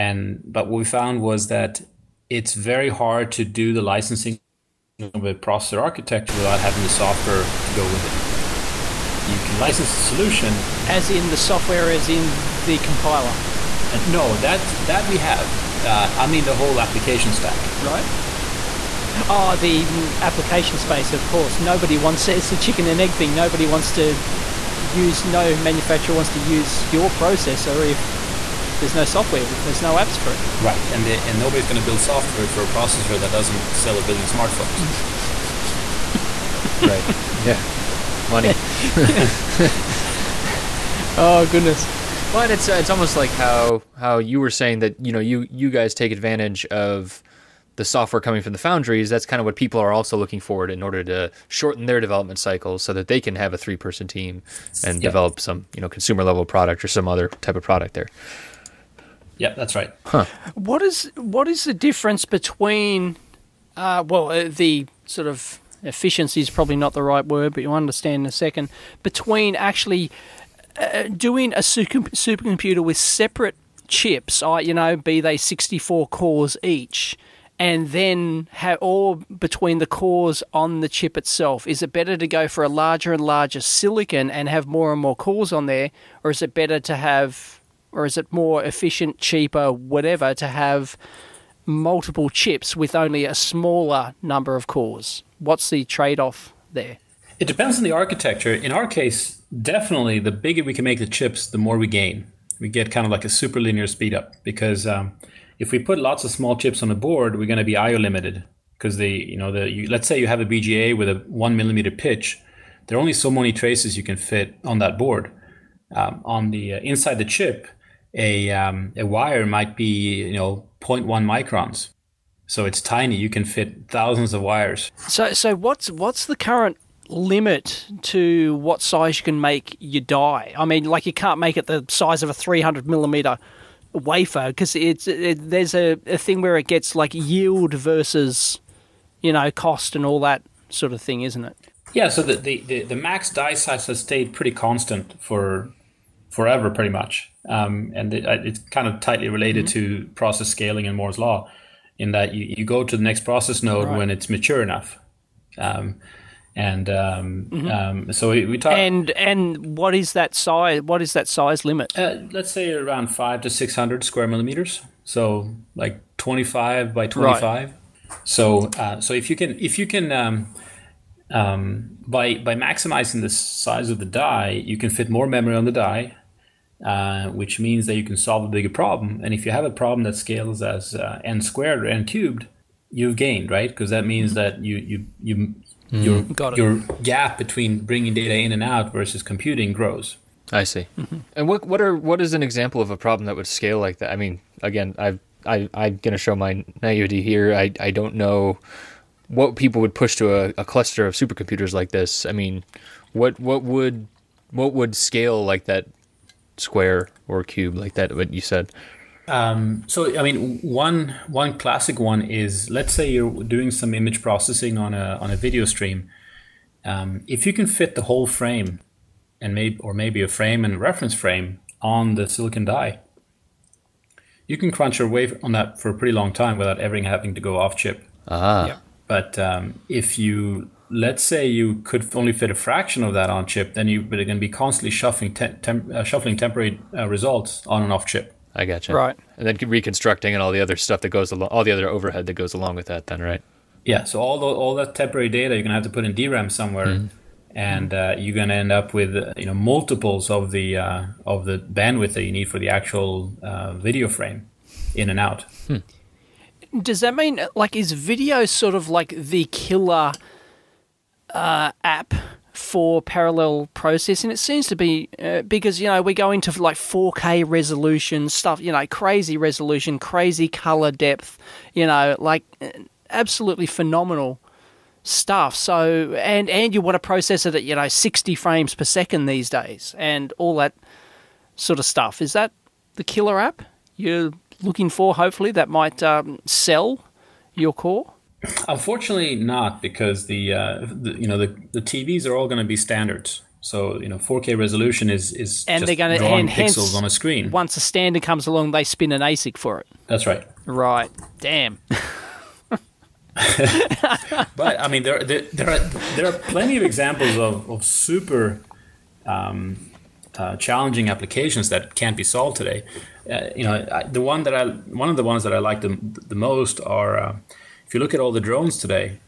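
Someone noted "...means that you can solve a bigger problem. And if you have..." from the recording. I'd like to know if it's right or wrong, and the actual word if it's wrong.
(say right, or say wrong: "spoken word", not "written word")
right.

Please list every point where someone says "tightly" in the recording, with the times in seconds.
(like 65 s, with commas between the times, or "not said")
148 s.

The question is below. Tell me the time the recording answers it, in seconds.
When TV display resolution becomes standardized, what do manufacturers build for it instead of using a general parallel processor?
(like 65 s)
299 s.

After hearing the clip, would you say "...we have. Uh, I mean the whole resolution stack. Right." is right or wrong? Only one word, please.
wrong.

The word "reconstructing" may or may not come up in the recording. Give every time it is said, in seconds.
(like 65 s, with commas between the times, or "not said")
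239 s.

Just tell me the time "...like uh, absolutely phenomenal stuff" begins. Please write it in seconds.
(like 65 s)
272 s.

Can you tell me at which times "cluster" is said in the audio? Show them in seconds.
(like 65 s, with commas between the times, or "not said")
200 s.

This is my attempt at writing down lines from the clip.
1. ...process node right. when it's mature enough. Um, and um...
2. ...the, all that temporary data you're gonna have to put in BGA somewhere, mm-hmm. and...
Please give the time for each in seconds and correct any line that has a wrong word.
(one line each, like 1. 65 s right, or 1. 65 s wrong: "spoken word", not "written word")
1. 153 s right
2. 244 s wrong: "DRAM", not "BGA".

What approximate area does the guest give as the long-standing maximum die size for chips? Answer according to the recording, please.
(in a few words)
500 to 600 square millimeters.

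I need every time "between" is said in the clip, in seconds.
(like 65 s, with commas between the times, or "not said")
62 s, 69 s, 79 s, 187 s.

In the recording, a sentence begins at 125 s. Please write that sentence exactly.
So so what's what's the current limit to what size you can make your die.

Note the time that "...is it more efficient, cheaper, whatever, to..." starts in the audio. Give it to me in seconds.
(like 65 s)
88 s.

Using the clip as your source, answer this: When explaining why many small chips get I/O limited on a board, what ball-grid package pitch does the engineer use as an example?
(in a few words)
1 millimeter.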